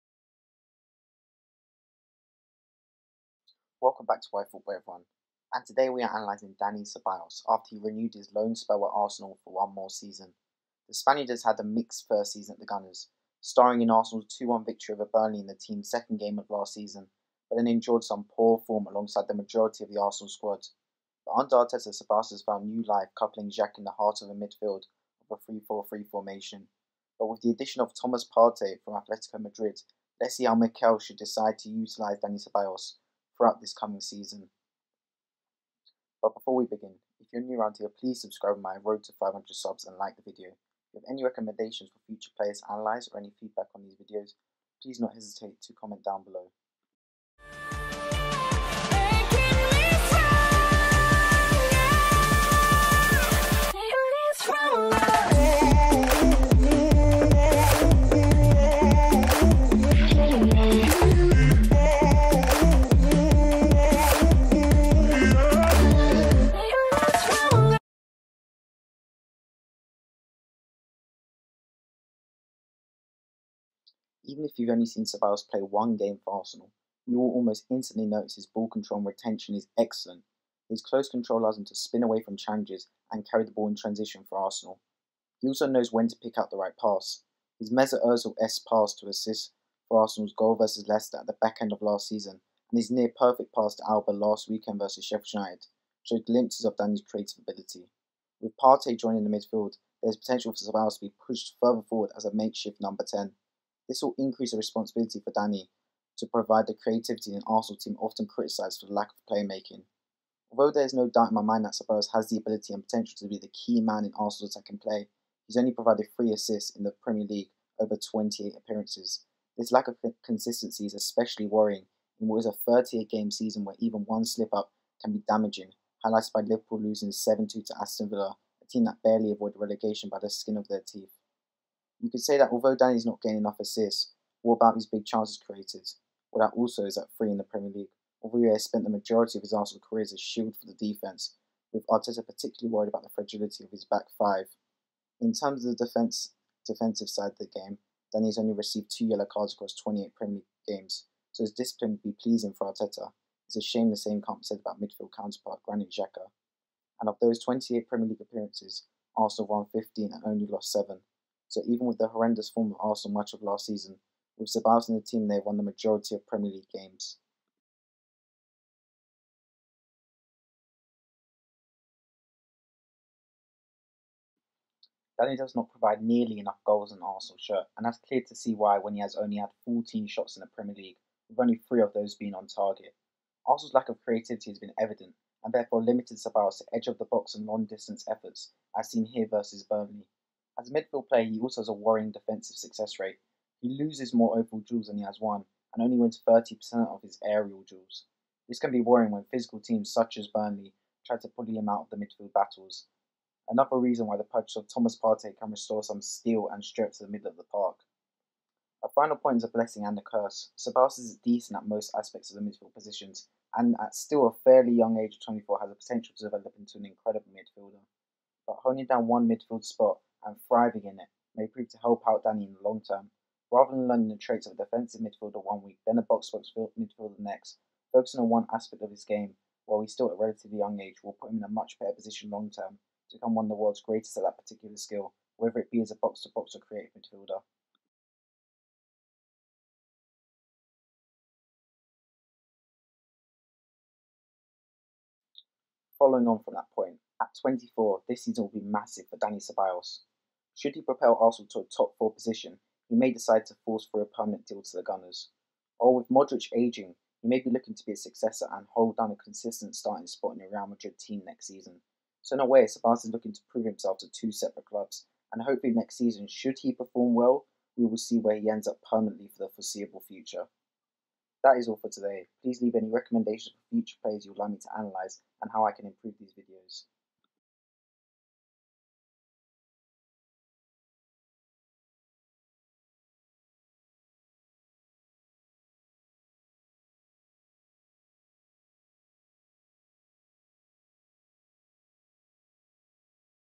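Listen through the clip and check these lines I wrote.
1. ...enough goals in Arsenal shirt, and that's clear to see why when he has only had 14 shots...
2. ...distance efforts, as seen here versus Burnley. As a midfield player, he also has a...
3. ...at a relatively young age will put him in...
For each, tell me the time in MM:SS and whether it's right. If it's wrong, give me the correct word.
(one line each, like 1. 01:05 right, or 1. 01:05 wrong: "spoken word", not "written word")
1. 02:56 right
2. 03:07 right
3. 03:50 right.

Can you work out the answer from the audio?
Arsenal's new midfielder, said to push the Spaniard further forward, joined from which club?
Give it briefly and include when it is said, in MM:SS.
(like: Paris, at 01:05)
Atletico Madrid, at 00:28.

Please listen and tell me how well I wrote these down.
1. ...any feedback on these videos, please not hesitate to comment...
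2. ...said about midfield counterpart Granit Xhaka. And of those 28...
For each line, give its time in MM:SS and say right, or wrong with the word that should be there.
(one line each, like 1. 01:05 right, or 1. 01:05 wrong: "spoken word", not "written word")
1. 00:43 right
2. 02:34 right.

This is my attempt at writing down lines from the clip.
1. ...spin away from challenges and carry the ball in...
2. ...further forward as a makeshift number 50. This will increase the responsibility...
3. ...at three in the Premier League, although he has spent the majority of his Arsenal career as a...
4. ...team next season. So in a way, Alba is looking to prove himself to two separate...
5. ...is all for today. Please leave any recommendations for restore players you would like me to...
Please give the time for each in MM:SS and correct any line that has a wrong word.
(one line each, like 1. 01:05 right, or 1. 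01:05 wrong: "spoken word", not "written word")
1. 01:21 right
2. 01:41 wrong: "10", not "50"
3. 02:16 right
4. 04:20 wrong: "Sabas", not "Alba"
5. 04:31 wrong: "future", not "restore".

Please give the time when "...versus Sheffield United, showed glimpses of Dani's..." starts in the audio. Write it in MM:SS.
01:34.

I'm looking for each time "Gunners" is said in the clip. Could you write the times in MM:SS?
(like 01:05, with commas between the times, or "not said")
00:12, 04:14.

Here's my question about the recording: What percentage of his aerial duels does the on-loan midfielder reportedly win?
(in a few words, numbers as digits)
30%.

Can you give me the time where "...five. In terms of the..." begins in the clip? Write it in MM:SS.
02:24.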